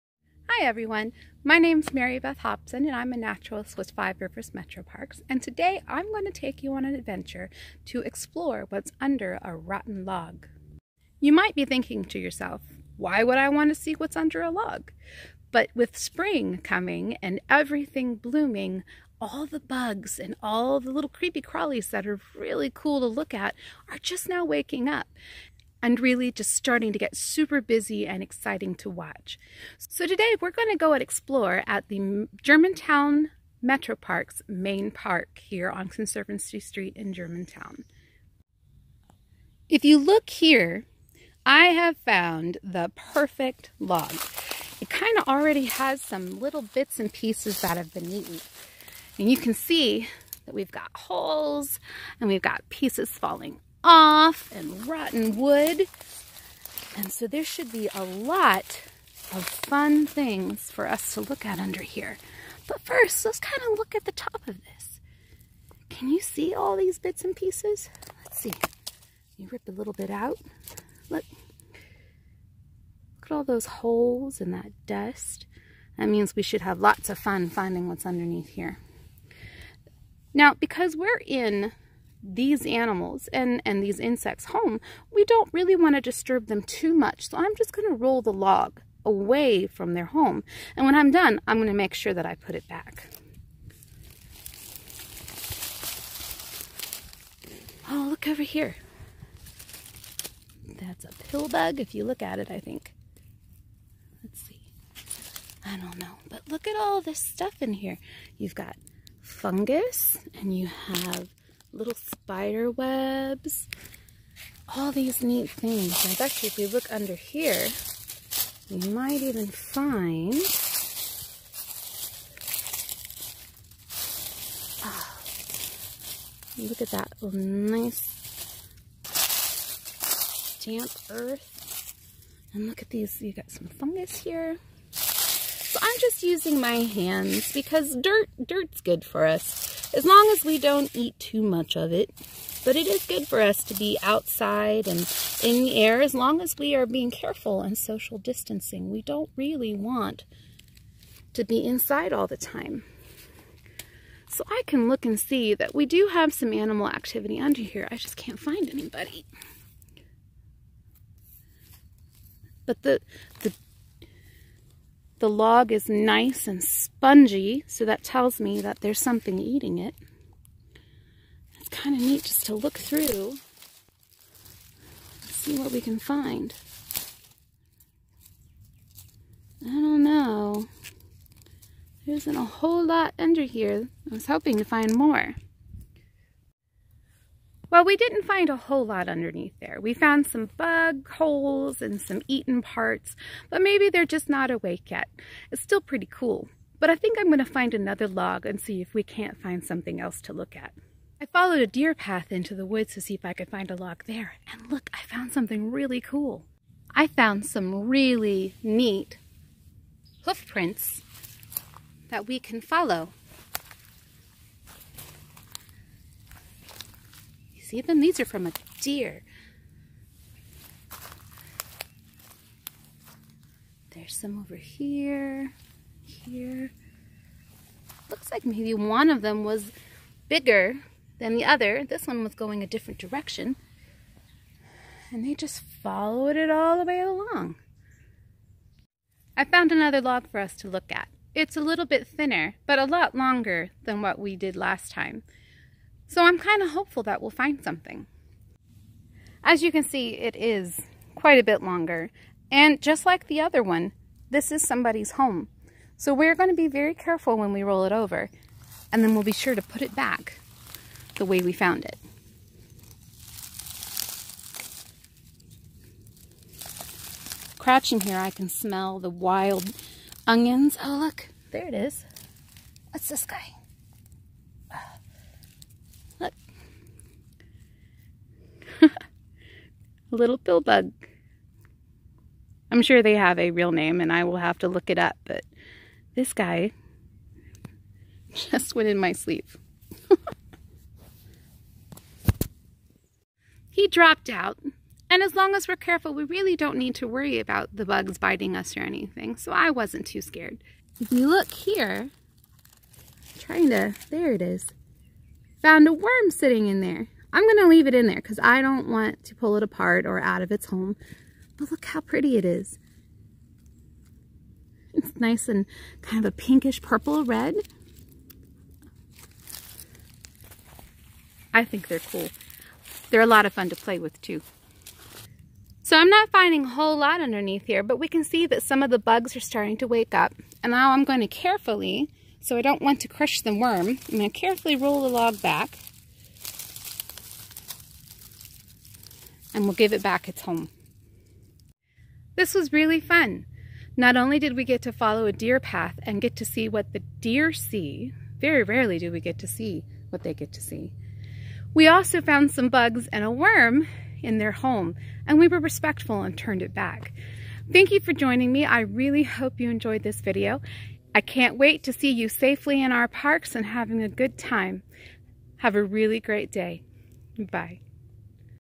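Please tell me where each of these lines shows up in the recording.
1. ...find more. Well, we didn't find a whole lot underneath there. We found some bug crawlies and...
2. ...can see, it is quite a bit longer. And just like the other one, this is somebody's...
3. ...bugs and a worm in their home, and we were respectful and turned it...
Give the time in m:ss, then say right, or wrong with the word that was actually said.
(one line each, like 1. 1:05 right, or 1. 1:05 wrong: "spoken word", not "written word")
1. 3:04 wrong: "holes", not "crawlies"
2. 4:09 right
3. 5:52 right.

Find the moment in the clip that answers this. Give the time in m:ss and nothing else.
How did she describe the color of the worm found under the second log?
5:16.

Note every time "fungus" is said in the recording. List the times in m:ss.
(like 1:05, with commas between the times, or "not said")
1:49, 2:13.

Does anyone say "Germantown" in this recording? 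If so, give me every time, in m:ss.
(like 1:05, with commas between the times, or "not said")
0:32, 0:37.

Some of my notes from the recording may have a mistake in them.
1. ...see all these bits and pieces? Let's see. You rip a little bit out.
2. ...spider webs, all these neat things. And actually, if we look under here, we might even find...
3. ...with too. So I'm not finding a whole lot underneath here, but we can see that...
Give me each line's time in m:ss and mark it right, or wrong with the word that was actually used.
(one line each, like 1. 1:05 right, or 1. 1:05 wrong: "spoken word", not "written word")
1. 1:06 right
2. 1:51 right
3. 5:23 right.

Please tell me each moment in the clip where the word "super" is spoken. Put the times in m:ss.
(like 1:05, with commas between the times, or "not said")
0:27.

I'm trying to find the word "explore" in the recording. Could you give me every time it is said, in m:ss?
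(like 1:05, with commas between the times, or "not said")
0:08, 0:31.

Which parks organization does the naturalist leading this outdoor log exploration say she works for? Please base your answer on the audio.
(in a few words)
Five Rivers Metro Parks.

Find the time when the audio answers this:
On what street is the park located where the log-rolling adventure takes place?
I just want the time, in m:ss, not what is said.
0:35.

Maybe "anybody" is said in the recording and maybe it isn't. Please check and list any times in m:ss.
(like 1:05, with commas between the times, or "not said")
2:38.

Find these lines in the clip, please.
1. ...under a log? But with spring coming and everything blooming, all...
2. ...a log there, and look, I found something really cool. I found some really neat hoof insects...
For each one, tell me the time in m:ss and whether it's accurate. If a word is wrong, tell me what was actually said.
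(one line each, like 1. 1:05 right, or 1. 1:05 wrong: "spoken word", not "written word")
1. 0:14 right
2. 3:23 wrong: "prints", not "insects".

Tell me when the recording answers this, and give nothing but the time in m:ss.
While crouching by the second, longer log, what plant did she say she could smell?
4:29.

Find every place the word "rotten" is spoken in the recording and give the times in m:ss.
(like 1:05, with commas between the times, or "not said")
0:09, 0:54.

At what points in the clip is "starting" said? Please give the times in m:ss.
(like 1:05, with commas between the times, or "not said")
0:26, 5:29.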